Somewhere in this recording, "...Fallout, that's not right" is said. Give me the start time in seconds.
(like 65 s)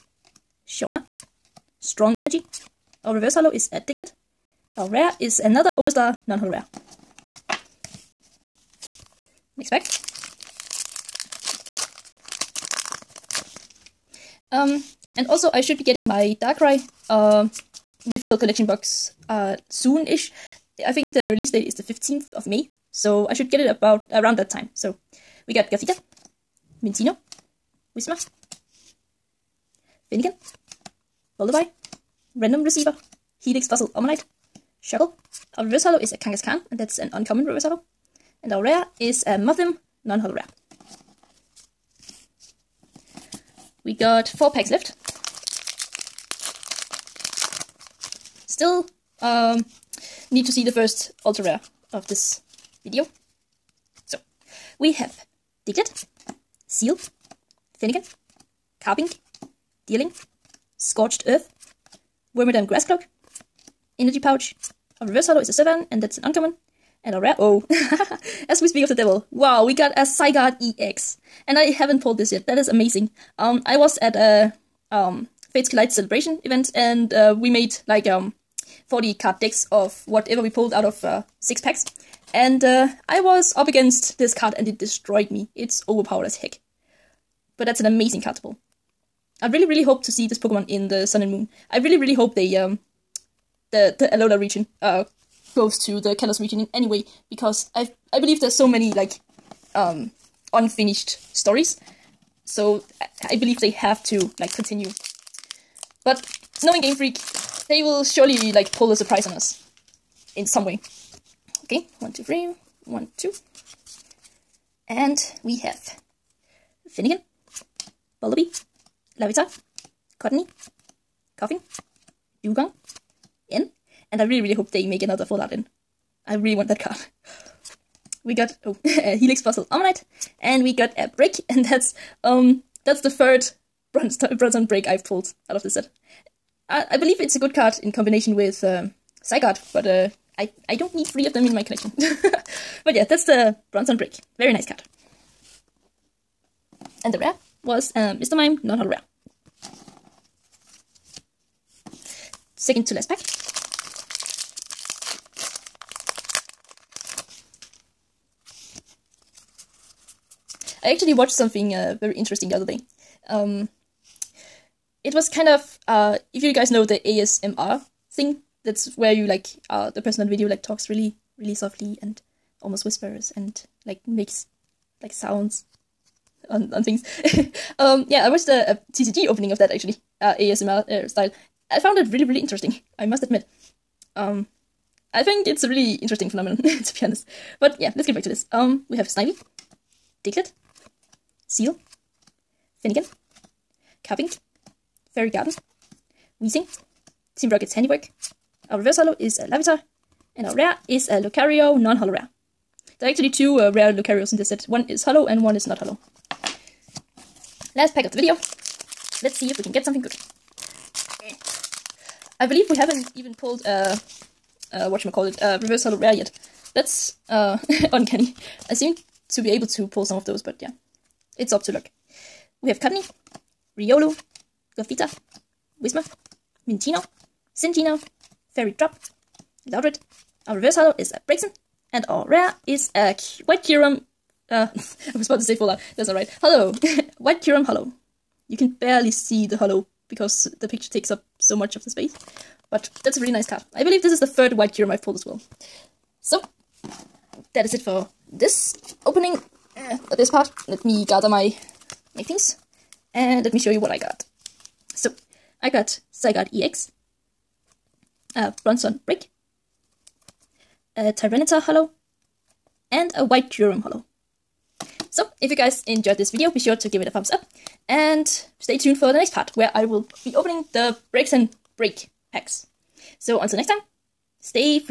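235 s.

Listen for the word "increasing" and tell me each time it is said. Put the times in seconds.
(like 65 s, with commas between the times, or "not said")
not said.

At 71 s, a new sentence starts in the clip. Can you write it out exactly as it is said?
And I haven't pulled this yet.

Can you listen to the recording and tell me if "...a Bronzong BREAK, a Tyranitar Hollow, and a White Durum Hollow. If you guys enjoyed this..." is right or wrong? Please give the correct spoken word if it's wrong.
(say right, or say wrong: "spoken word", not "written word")
right.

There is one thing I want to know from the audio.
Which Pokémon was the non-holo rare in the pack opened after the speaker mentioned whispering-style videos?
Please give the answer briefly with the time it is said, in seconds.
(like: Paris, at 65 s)
Lucario, at 201 s.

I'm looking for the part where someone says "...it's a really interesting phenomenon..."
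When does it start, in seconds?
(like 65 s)
185 s.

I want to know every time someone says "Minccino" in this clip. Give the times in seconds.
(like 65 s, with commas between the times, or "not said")
26 s, 226 s.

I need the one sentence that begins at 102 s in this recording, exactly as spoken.
So I believe they have to like continue.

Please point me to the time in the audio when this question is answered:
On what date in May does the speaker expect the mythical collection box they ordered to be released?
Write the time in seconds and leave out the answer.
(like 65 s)
21 s.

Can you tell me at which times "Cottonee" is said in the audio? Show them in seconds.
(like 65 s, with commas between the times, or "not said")
120 s, 222 s.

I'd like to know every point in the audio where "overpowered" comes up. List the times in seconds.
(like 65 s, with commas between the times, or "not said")
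85 s.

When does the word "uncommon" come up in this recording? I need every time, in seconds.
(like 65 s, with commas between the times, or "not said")
37 s, 66 s.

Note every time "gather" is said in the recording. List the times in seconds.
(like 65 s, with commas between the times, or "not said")
251 s.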